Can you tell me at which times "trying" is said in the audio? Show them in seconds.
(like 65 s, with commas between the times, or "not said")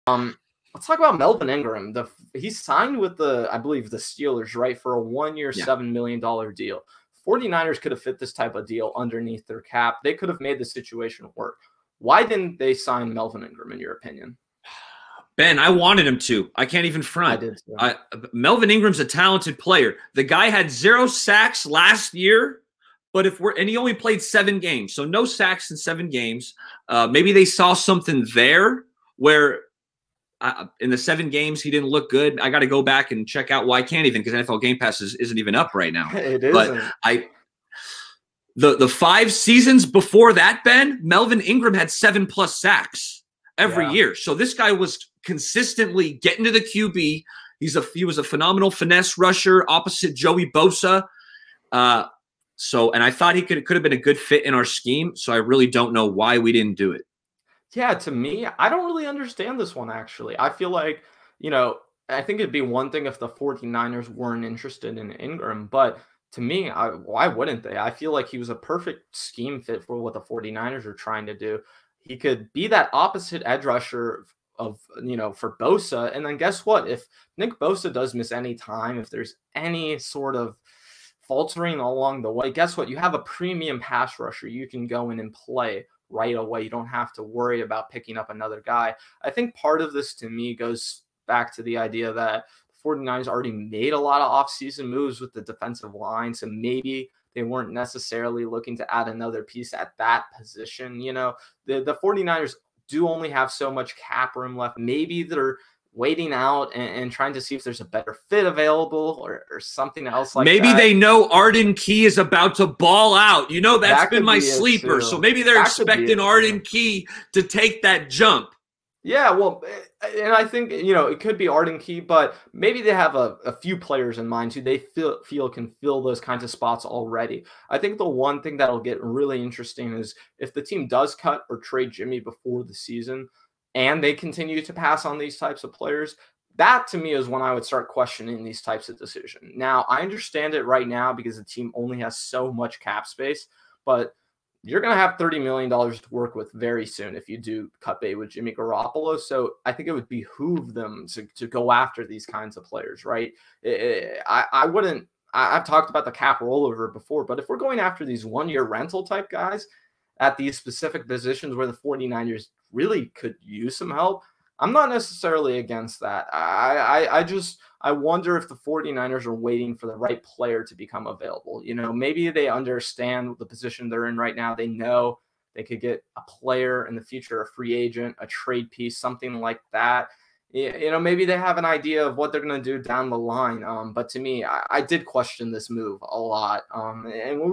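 70 s, 107 s.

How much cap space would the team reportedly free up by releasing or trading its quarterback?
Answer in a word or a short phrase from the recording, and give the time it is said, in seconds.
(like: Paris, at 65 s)
$30 million, at 145 s.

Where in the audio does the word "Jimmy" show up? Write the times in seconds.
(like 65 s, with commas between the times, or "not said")
131 s, 148 s.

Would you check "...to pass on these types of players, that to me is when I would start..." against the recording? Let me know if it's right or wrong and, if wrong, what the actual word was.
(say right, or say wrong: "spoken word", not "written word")
right.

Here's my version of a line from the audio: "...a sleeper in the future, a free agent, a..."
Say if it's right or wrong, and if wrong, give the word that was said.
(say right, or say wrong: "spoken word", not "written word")
wrong: "player", not "sleeper".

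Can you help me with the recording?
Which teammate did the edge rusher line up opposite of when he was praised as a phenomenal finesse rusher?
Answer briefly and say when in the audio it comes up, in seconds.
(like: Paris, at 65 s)
Joey Bosa, at 50 s.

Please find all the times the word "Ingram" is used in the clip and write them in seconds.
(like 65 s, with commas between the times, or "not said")
1 s, 13 s, 18 s, 41 s, 65 s.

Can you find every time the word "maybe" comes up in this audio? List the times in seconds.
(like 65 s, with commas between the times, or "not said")
27 s, 96 s, 104 s, 110 s, 115 s, 122 s, 171 s, 180 s.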